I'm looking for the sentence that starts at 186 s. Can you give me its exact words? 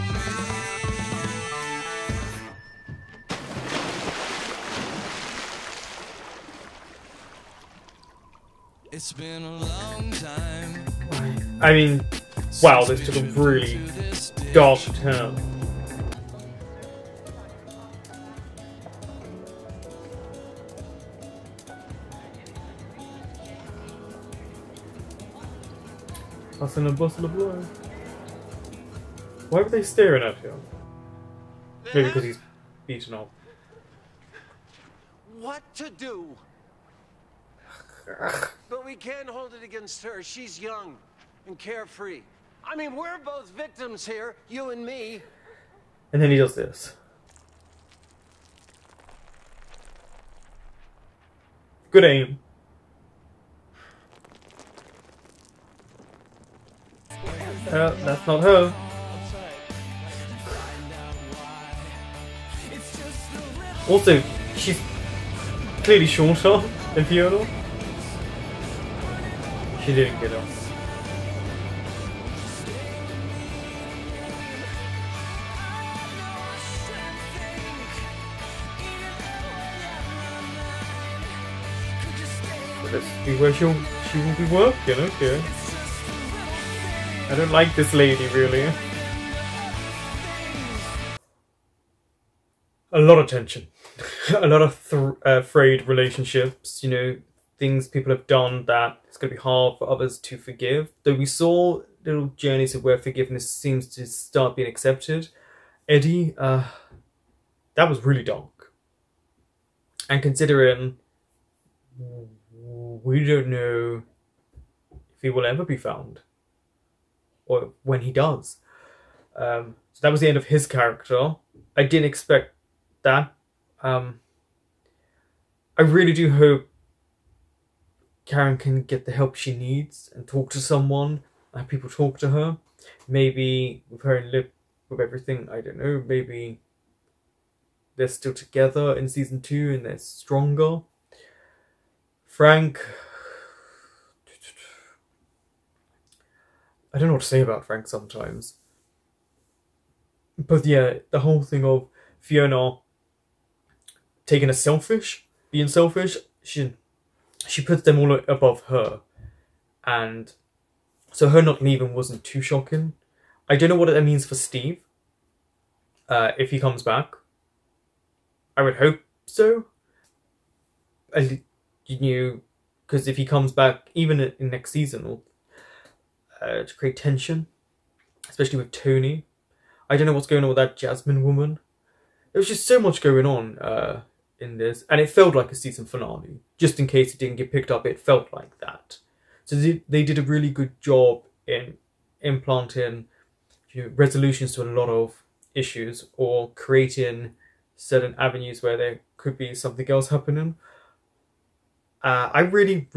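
Just in case it didn't get picked up, it felt like that.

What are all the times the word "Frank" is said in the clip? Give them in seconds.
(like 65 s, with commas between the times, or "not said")
142 s, 147 s.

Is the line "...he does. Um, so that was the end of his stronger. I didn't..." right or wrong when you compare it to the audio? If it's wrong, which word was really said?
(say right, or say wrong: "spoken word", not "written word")
wrong: "character", not "stronger".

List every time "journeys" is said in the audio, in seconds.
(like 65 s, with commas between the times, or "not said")
102 s.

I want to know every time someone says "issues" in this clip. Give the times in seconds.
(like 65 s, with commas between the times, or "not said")
195 s.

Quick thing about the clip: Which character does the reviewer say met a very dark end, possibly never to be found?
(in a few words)
Eddie.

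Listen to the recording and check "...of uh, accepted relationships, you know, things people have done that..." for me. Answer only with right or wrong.
wrong.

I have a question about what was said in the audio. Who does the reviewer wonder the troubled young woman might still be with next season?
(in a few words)
Lip.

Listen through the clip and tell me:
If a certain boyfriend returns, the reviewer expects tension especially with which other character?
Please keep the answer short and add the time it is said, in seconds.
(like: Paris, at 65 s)
Tony, at 178 s.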